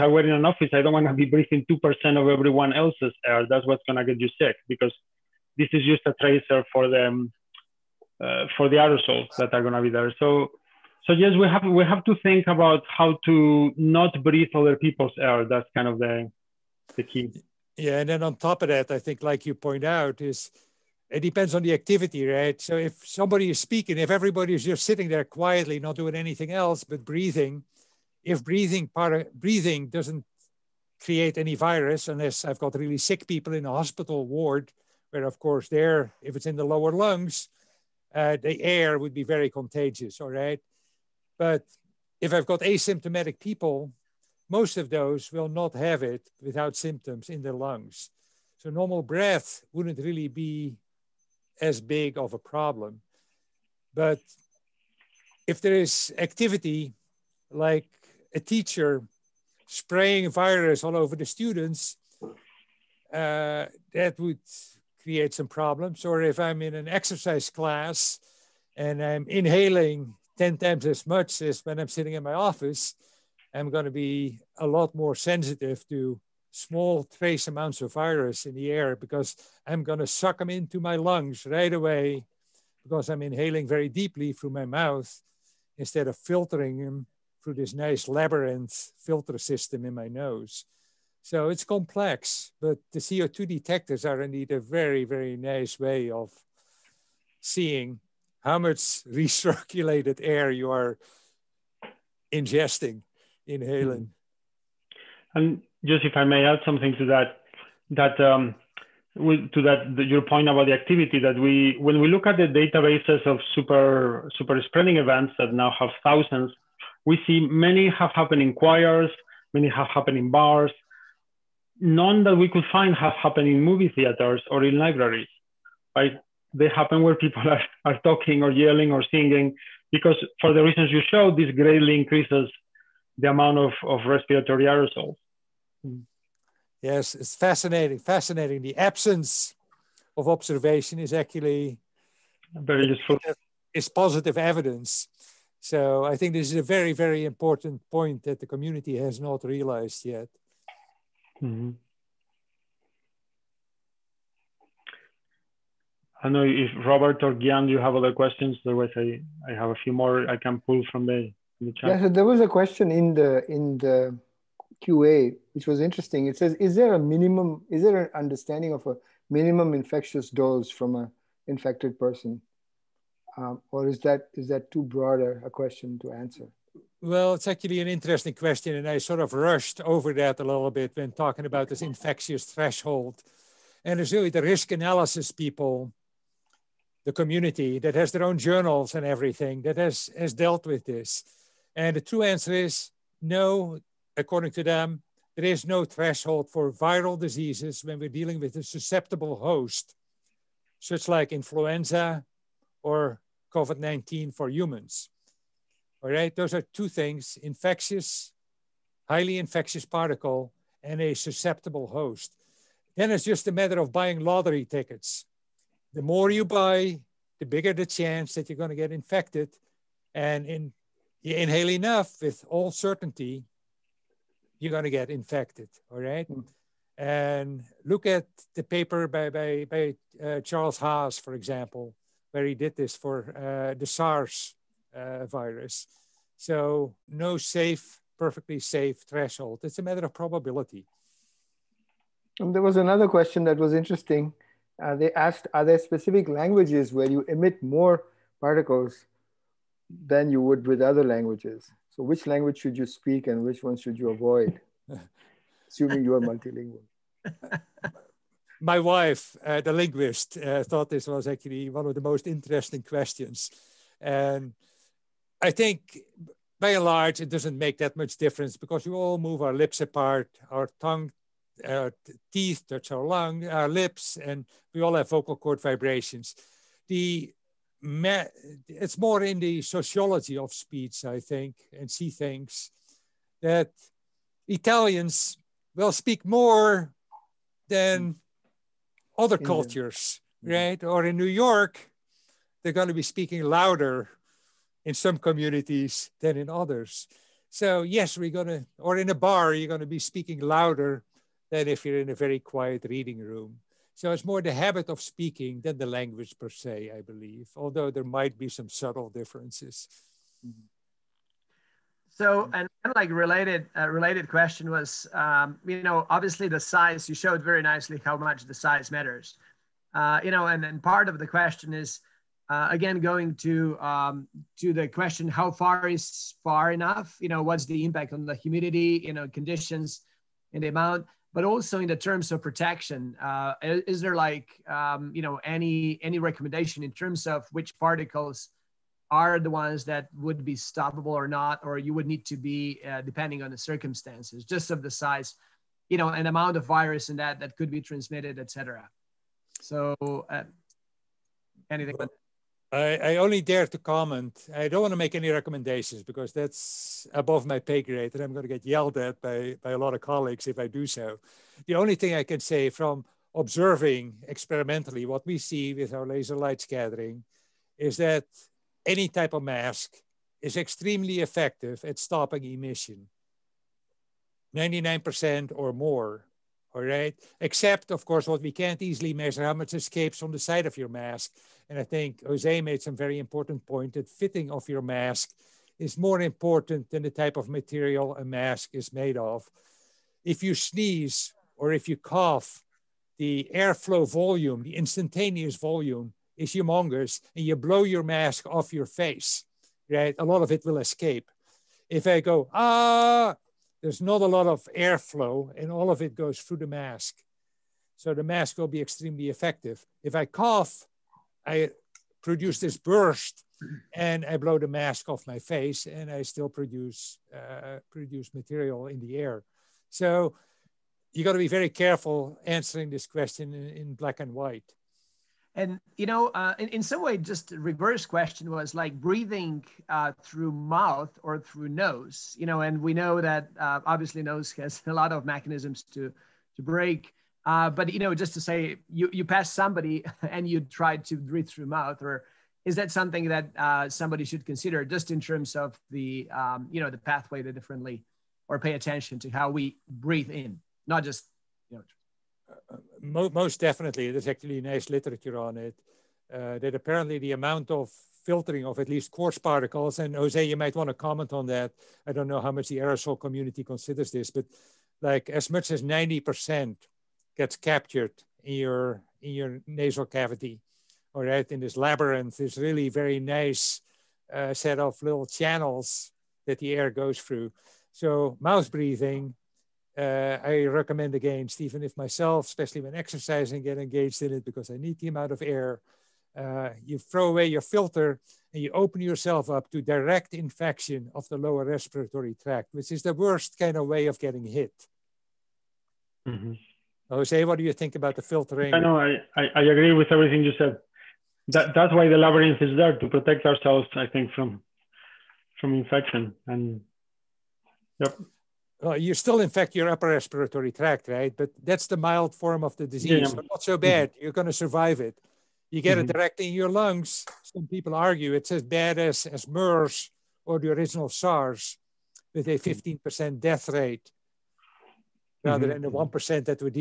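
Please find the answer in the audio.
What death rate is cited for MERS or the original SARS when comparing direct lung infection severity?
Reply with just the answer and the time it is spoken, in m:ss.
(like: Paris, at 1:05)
15%, at 8:42.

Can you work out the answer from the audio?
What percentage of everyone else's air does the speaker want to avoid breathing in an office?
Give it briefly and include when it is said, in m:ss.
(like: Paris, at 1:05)
2%, at 0:01.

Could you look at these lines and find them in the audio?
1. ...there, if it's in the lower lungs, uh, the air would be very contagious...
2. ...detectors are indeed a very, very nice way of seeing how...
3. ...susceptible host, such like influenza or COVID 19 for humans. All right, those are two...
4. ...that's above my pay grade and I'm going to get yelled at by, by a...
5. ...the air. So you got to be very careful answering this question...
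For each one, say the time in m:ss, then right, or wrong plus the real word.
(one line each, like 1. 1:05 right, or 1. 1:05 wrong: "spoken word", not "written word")
1. 0:35 right
2. 1:33 right
3. 3:18 right
4. 5:56 right
5. 6:59 right.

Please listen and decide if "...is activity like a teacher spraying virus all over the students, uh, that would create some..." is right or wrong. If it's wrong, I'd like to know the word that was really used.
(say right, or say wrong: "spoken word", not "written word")
right.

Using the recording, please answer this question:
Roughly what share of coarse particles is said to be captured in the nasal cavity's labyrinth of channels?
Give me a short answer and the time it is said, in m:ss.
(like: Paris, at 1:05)
90%, at 7:45.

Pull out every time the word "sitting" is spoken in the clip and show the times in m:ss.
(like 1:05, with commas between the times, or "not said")
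0:24, 1:11.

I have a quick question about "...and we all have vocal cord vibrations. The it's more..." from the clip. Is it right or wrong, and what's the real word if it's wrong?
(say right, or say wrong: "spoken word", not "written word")
right.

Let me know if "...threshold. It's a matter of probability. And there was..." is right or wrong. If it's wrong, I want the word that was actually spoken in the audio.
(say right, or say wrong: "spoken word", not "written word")
right.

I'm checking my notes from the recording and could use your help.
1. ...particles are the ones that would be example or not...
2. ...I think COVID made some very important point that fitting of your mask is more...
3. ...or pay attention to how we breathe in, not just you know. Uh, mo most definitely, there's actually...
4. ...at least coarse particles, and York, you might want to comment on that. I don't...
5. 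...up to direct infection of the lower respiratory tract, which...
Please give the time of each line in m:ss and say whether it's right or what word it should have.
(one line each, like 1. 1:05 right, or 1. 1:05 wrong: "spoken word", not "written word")
1. 5:37 wrong: "stoppable", not "example"
2. 6:21 wrong: "Jose", not "COVID"
3. 7:28 right
4. 7:38 wrong: "Jose", not "York"
5. 8:09 right.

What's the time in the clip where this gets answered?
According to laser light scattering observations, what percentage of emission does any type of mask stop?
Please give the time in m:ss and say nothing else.
6:14.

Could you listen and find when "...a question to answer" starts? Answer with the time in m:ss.
2:55.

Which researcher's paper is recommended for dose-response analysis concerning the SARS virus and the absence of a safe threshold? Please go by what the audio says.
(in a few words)
Charles Haas.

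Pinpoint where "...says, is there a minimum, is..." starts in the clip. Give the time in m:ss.
2:46.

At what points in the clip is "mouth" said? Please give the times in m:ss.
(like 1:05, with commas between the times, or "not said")
1:24, 7:10, 7:21, 7:58.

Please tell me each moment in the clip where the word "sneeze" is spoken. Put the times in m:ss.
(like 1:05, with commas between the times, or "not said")
6:30.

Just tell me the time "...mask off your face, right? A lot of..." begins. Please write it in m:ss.
6:38.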